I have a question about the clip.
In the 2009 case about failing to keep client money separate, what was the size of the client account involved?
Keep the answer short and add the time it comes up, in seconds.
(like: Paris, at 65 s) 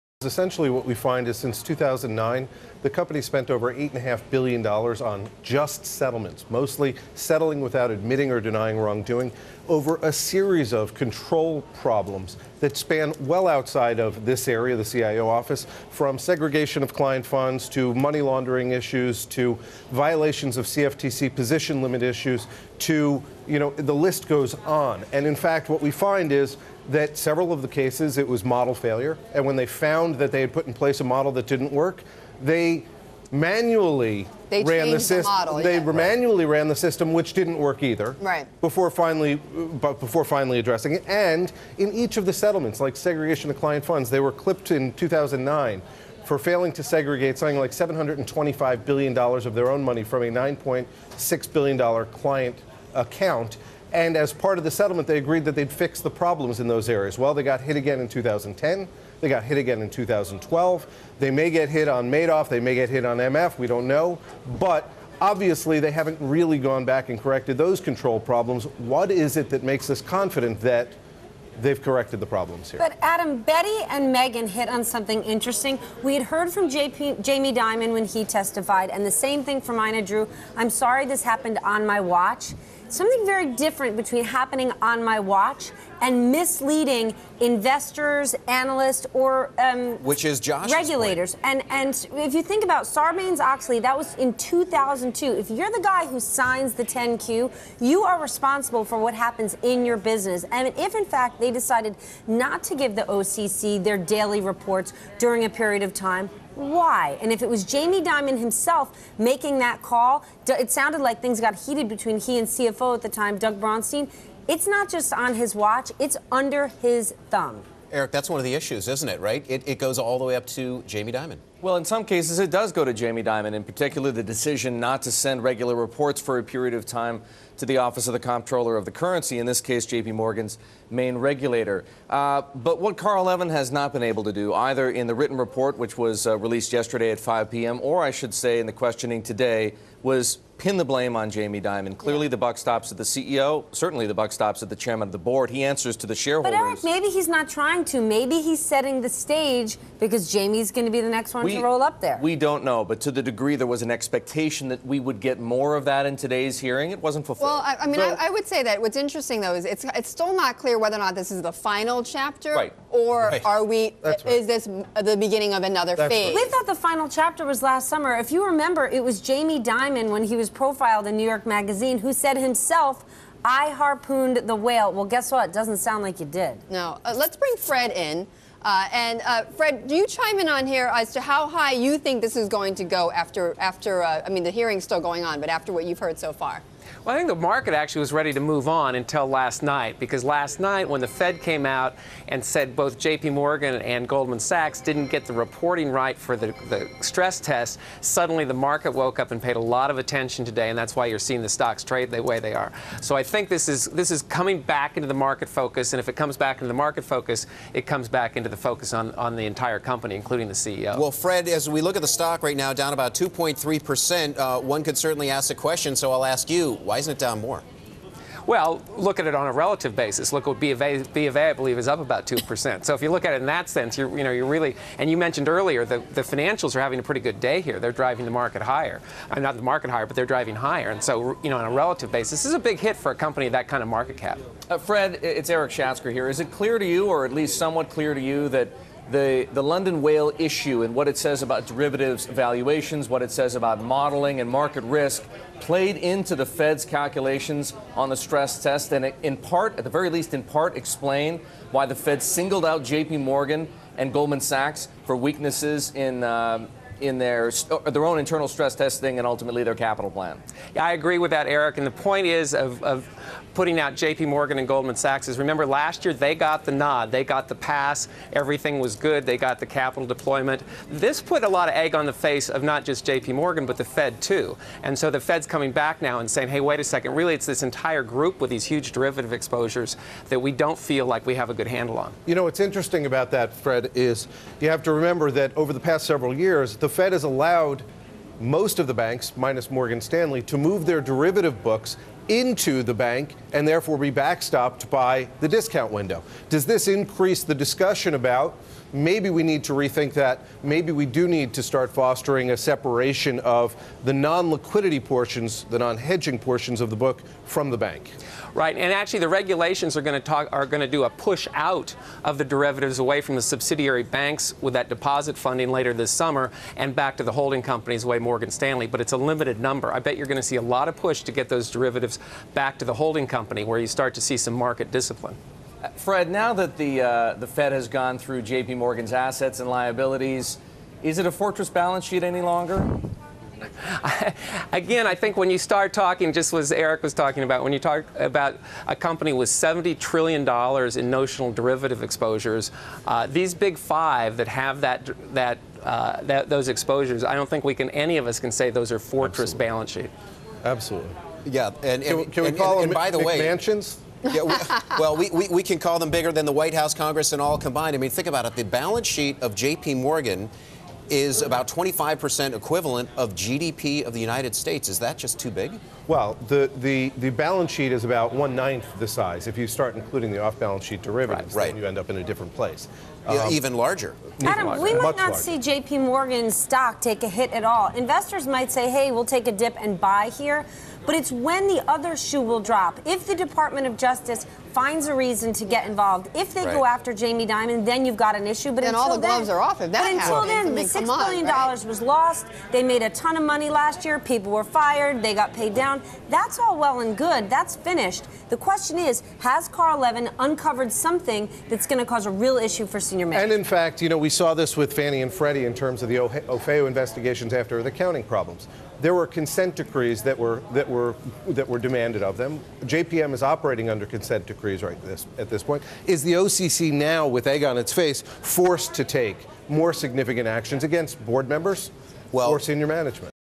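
$9.6 billion, at 50 s.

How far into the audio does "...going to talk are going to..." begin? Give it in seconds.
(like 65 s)
310 s.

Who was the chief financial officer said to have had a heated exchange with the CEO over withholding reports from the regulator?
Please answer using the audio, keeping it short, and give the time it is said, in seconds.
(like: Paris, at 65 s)
Doug Braunstein, at 113 s.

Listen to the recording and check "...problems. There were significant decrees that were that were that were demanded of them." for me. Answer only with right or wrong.
wrong.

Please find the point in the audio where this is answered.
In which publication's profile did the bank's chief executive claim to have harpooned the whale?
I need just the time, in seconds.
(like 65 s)
171 s.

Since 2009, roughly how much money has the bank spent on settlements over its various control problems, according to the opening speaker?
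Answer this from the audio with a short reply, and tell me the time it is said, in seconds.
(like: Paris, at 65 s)
$8.5 billion, at 3 s.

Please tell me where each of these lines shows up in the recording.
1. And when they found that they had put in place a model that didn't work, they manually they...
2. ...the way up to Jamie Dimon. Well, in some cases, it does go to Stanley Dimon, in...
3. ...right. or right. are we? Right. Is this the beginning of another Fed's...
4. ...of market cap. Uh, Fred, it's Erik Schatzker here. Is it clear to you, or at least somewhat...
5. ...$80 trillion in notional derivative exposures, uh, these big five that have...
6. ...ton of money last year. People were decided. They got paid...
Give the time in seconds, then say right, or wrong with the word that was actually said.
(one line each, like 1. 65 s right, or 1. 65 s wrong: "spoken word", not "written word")
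1. 29 s right
2. 120 s wrong: "Jamie", not "Stanley"
3. 162 s wrong: "That", not "Fed"
4. 233 s right
5. 339 s wrong: "70", not "80"
6. 393 s wrong: "fired", not "decided".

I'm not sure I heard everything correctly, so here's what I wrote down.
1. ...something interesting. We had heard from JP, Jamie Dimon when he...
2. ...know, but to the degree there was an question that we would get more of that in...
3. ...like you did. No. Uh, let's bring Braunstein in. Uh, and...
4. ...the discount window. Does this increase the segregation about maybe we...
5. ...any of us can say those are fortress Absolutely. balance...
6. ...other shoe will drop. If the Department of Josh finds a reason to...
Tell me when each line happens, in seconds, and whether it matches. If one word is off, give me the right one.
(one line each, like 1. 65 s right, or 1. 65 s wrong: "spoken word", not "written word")
1. 74 s right
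2. 152 s wrong: "expectation", not "question"
3. 176 s wrong: "Fred", not "Braunstein"
4. 295 s wrong: "discussion", not "segregation"
5. 347 s right
6. 381 s wrong: "Justice", not "Josh".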